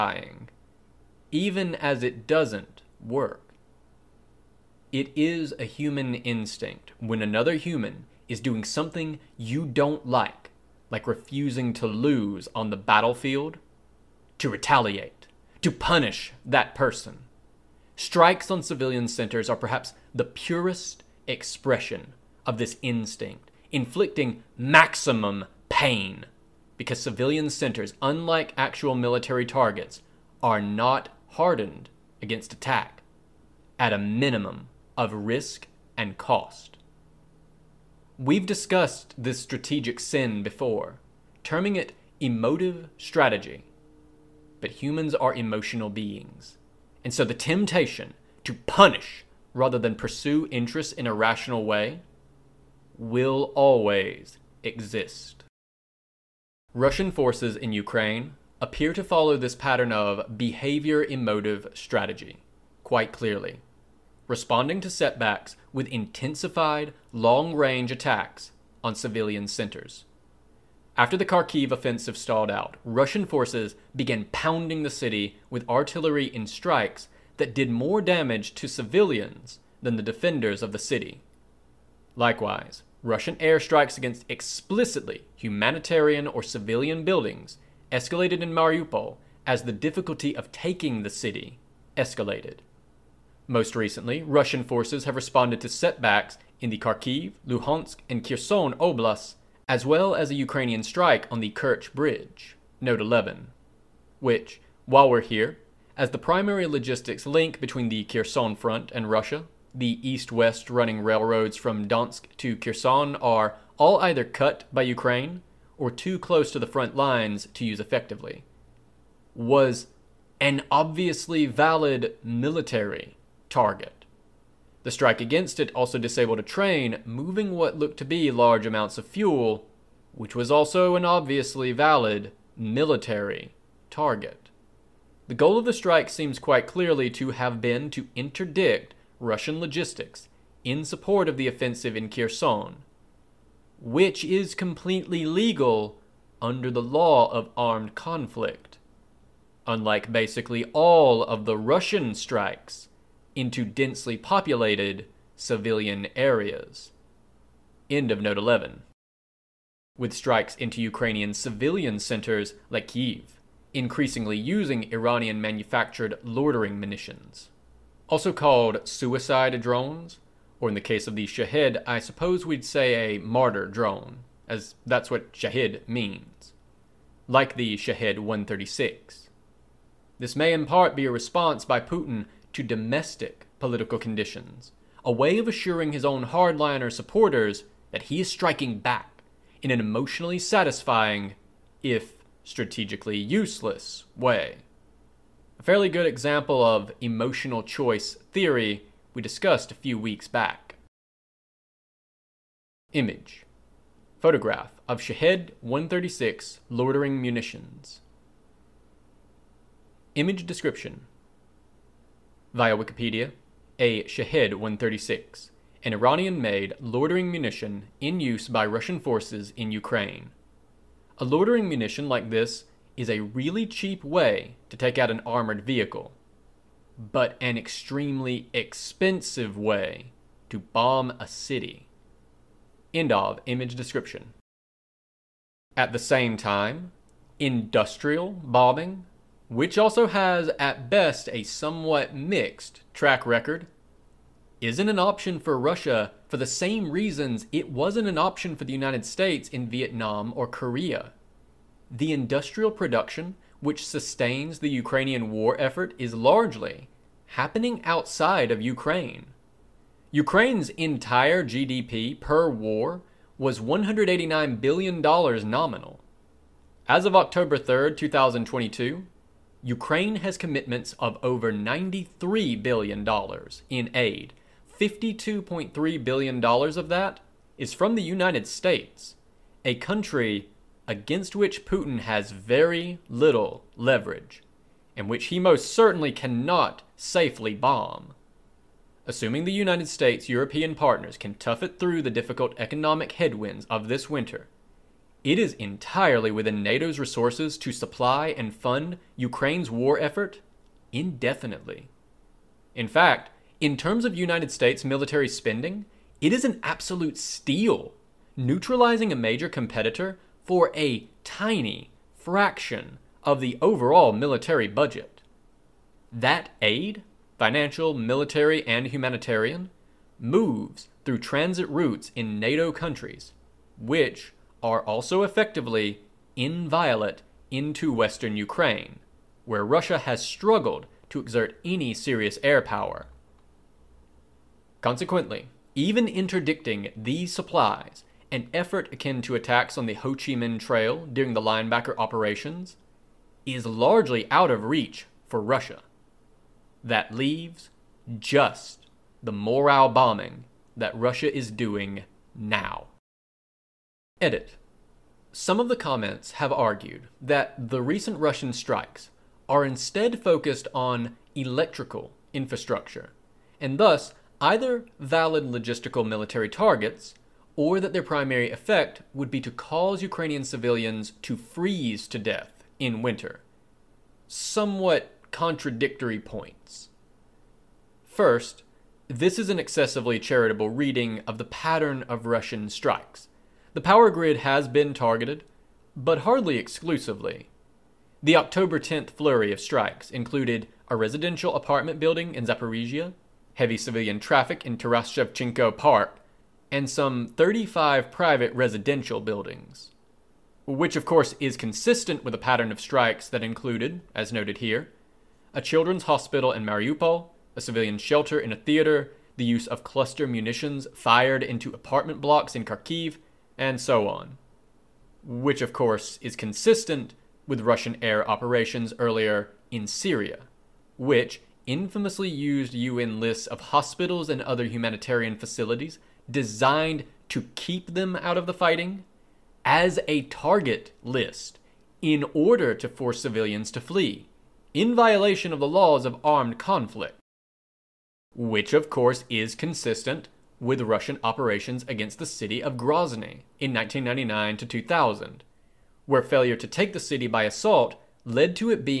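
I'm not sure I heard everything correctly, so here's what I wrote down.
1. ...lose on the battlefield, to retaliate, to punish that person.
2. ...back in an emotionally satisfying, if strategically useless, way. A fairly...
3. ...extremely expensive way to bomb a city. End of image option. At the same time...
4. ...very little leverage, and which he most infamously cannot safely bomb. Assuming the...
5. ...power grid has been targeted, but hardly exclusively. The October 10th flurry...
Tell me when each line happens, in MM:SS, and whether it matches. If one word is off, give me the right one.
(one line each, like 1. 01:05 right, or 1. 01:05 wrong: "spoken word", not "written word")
1. 00:11 right
2. 03:08 right
3. 03:47 wrong: "description", not "option"
4. 04:42 wrong: "certainly", not "infamously"
5. 06:23 right.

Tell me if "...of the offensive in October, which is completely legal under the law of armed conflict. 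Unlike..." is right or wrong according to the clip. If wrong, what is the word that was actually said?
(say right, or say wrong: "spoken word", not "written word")
wrong: "Kherson", not "October".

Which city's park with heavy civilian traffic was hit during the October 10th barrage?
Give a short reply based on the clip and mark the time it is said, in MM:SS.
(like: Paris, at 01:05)
Taras Shevchenko Park, at 06:34.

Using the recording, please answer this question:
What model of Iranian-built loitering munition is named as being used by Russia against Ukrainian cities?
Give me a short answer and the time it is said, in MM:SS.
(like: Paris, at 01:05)
Shahid 136, at 02:57.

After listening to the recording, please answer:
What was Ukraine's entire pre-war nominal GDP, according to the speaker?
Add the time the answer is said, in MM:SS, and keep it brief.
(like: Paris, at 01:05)
$189 billion, at 04:23.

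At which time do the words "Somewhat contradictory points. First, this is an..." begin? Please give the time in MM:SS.
06:14.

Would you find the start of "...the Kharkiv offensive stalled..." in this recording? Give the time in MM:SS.
01:11.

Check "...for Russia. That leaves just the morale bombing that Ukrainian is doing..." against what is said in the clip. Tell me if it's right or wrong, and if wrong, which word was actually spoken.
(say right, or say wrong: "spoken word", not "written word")
wrong: "Russia", not "Ukrainian".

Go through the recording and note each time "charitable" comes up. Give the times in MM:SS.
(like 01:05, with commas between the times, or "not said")
06:20.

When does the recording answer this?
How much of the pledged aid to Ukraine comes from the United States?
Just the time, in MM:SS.
04:34.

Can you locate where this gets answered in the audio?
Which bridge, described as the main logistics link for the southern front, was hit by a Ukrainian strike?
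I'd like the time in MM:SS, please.
01:41.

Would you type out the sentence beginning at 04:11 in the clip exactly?
The industrial production which sustains the Ukrainian war effort is largely happening outside of Ukraine.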